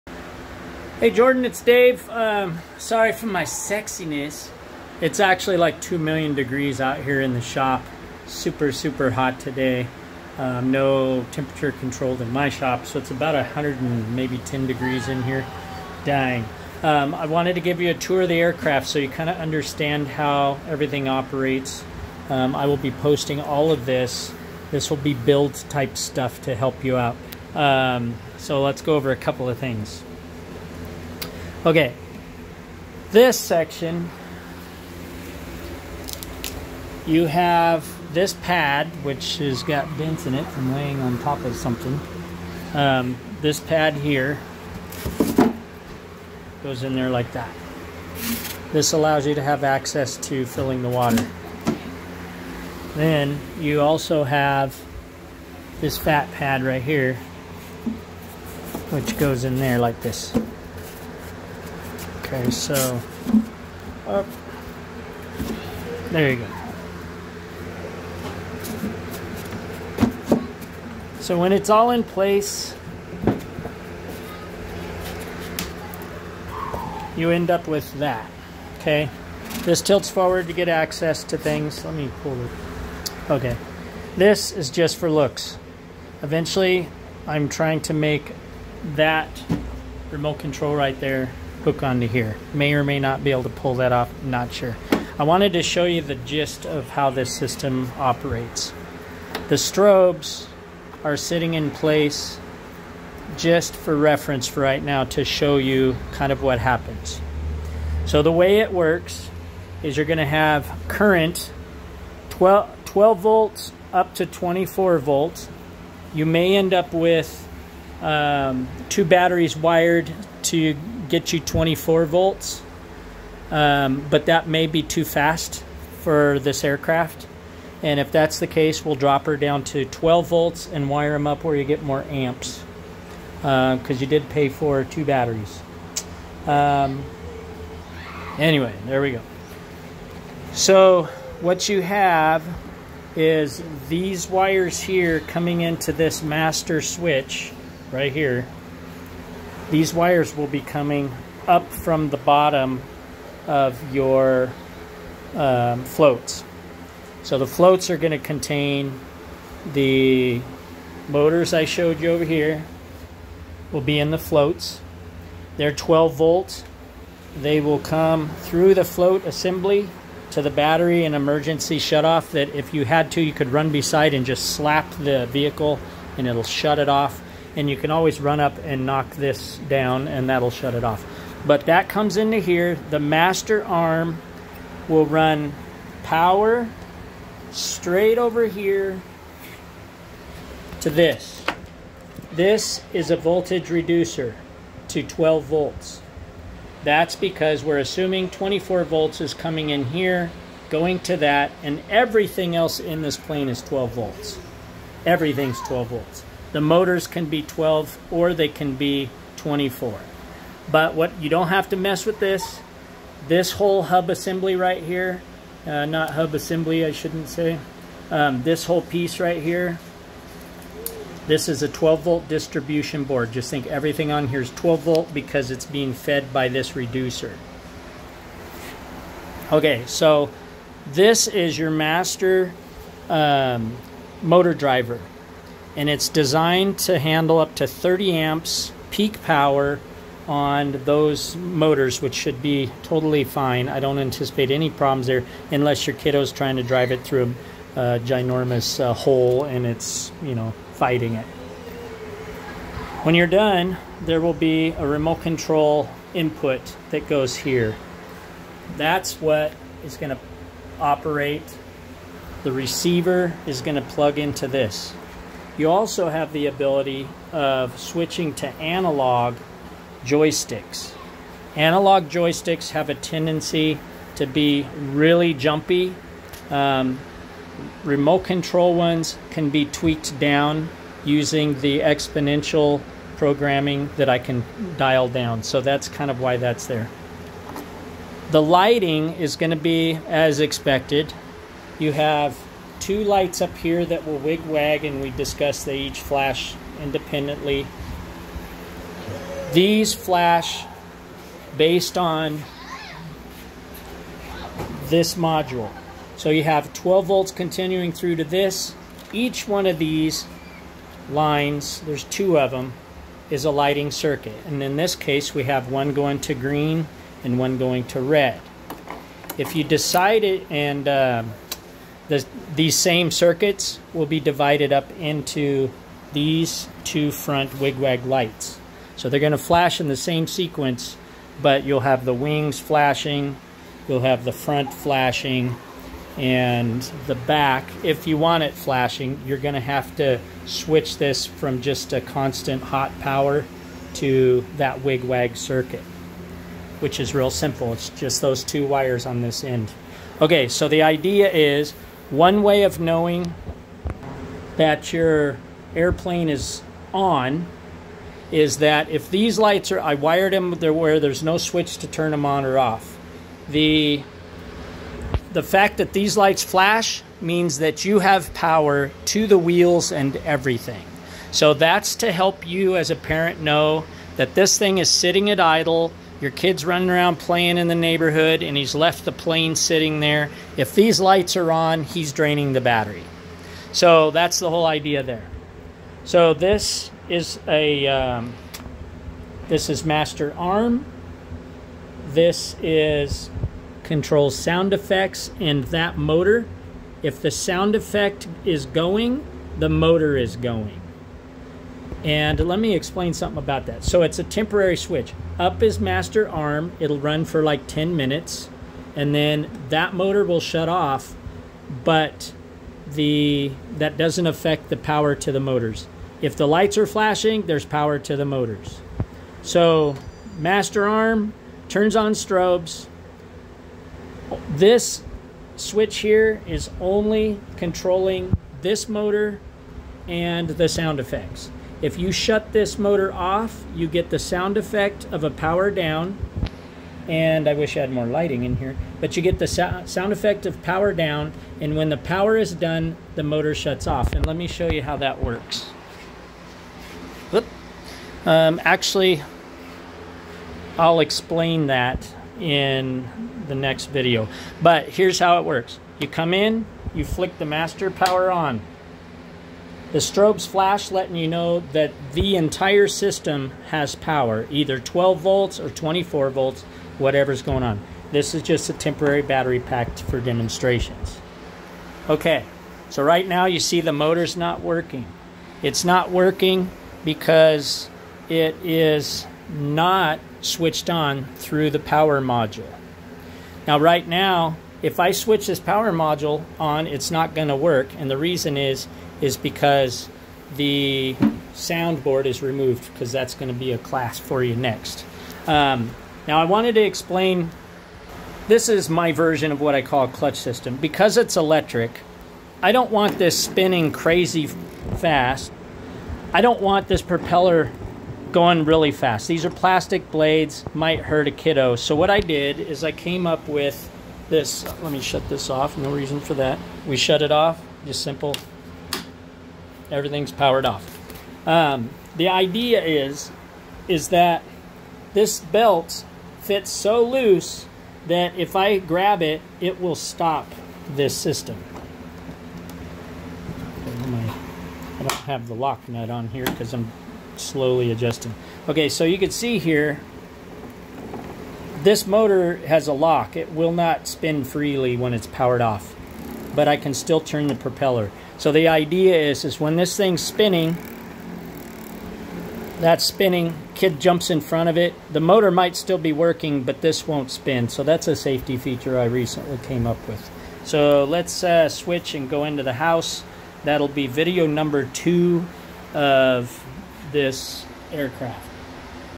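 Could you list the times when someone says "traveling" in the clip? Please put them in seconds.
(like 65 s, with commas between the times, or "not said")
not said.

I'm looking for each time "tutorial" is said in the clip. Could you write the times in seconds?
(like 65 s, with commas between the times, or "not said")
not said.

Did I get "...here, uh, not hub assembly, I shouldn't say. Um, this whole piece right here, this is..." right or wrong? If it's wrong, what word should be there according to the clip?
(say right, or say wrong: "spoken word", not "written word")
right.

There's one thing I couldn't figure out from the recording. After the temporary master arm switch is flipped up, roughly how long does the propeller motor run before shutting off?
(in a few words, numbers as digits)
10 minutes.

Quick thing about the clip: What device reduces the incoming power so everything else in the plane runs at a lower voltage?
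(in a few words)
voltage reducer.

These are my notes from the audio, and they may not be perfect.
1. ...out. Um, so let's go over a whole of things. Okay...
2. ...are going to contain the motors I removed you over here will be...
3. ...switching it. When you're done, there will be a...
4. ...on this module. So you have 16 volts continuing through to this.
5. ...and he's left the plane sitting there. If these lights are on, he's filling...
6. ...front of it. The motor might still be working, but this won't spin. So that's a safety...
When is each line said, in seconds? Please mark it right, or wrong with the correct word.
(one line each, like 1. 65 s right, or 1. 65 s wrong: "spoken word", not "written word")
1. 26 s wrong: "couple", not "whole"
2. 157 s wrong: "showed", not "removed"
3. 250 s wrong: "fighting", not "switching"
4. 301 s wrong: "12", not "16"
5. 378 s wrong: "draining", not "filling"
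6. 554 s right.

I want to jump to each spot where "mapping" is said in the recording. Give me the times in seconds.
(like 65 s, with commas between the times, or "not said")
not said.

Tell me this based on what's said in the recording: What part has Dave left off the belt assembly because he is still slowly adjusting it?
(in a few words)
lock nut.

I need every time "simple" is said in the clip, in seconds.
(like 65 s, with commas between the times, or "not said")
347 s, 518 s.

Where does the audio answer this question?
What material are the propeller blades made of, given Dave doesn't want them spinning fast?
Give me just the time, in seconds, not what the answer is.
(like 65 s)
509 s.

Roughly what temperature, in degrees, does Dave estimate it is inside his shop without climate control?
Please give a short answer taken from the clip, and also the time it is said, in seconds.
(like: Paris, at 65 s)
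110, at 13 s.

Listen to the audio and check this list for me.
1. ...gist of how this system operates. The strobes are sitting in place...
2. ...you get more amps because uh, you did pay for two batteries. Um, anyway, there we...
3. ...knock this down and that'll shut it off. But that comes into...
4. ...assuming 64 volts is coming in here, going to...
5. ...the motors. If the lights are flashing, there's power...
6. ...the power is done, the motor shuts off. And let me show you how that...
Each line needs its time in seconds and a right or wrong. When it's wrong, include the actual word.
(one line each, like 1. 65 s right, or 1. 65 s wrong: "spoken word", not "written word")
1. 96 s right
2. 131 s right
3. 178 s right
4. 197 s wrong: "24", not "64"
5. 415 s right
6. 441 s right.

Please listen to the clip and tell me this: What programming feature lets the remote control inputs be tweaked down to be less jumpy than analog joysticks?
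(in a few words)
exponential programming.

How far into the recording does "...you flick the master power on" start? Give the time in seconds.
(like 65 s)
456 s.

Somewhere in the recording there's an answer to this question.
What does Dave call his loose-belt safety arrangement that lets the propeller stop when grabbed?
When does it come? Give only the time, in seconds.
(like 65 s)
500 s.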